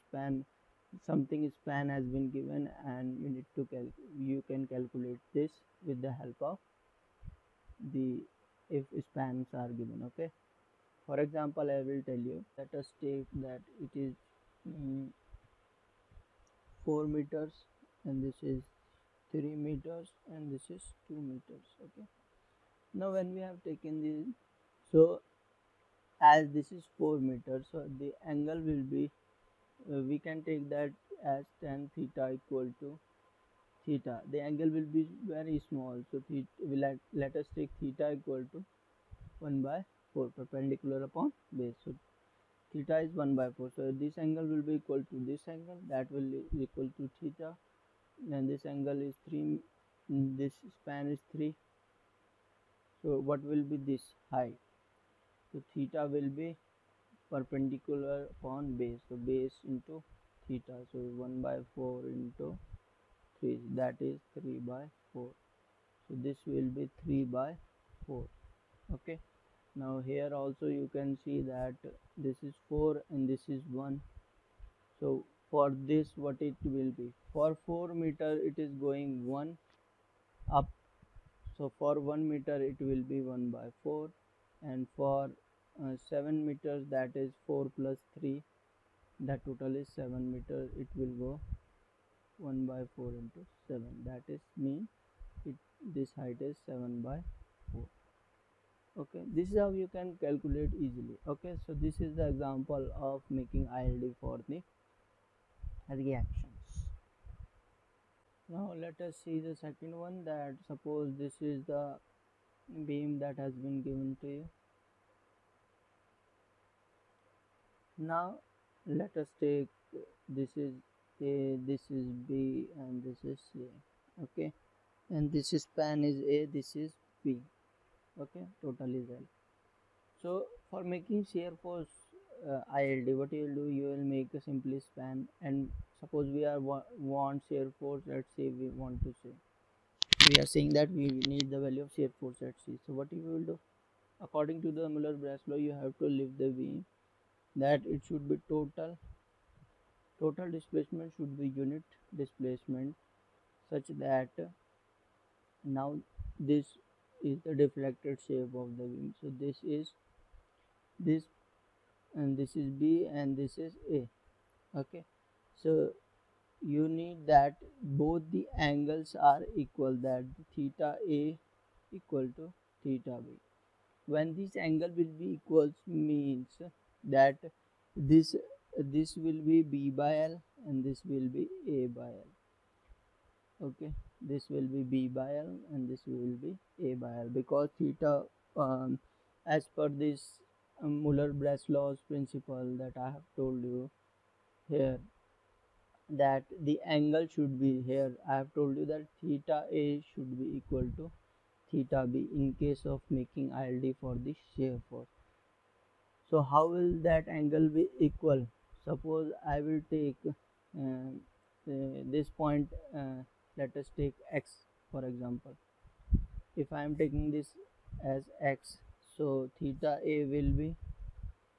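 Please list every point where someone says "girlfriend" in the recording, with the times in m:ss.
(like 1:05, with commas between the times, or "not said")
not said.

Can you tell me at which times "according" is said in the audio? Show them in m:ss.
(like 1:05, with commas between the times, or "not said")
2:24.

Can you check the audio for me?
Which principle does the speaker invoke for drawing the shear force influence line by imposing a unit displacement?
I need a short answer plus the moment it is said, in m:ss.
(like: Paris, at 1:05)
Muller-Breslau, at 2:24.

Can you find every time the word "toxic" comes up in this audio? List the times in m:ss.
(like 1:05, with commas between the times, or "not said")
not said.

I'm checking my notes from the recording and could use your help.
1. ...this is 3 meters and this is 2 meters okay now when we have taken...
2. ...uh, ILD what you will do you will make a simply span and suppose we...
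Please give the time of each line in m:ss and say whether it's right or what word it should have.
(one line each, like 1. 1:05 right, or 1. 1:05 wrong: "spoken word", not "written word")
1. 0:18 right
2. 2:12 right.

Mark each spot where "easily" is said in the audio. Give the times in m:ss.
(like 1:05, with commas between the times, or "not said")
1:40.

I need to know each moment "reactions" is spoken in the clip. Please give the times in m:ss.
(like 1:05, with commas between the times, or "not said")
1:45.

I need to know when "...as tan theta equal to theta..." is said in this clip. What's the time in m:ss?
0:31.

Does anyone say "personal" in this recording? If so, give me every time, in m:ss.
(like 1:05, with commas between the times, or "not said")
not said.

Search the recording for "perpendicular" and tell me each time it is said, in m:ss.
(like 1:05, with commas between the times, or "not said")
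0:40, 0:57.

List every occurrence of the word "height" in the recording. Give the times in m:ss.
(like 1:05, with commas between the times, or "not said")
0:54, 1:36.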